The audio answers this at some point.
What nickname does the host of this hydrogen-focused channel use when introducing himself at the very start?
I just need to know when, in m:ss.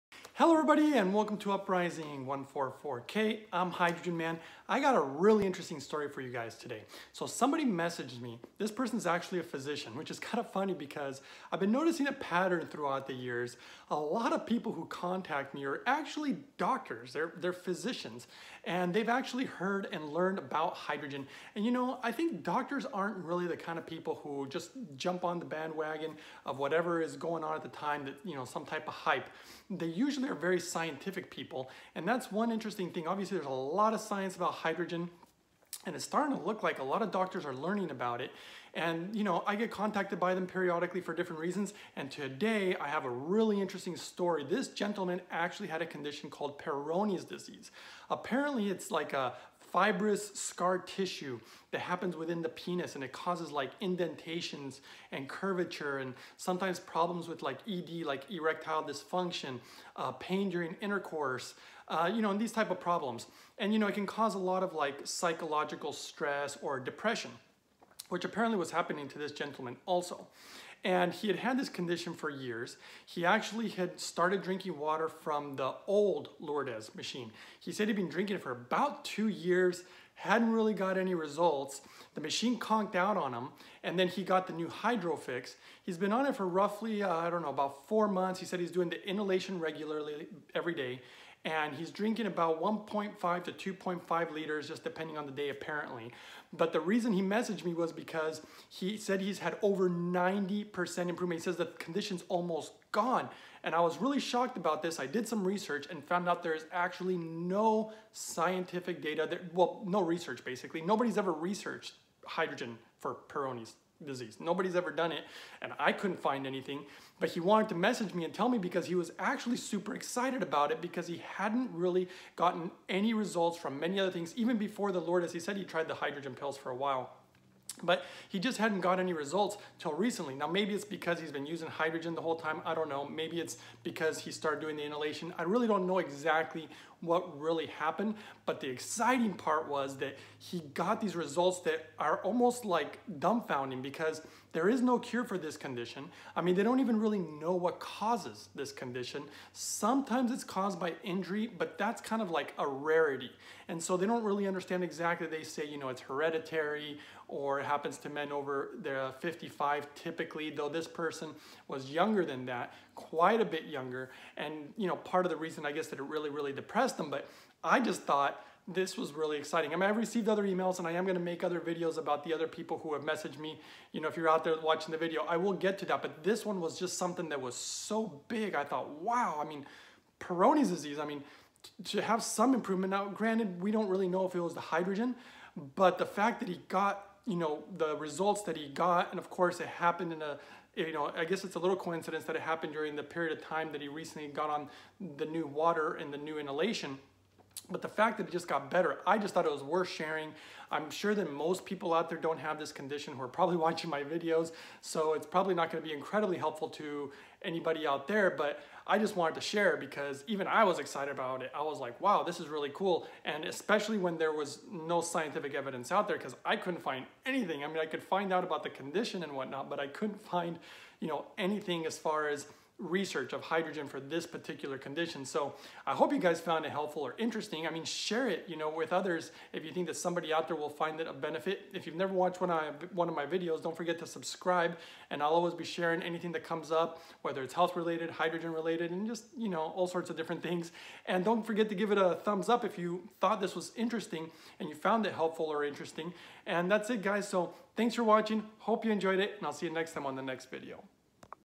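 0:03.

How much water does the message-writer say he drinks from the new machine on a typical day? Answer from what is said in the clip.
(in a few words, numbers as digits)
1.5 to 2.5 liters.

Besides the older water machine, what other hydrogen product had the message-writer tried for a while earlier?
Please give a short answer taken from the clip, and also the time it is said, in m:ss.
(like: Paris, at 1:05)
hydrogen pills, at 2:05.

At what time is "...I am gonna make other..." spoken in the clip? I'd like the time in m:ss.
2:50.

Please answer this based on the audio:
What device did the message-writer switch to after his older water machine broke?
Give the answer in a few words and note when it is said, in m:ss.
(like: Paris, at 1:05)
Hydrofix, at 1:24.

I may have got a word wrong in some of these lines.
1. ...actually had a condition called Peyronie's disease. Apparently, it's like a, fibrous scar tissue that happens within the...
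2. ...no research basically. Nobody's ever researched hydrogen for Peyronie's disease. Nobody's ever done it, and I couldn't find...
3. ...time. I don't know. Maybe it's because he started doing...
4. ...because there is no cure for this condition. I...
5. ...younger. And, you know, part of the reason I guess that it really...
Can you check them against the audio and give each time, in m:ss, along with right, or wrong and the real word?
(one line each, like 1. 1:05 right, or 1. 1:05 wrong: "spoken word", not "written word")
1. 0:45 right
2. 1:49 right
3. 2:12 right
4. 2:23 right
5. 2:43 right.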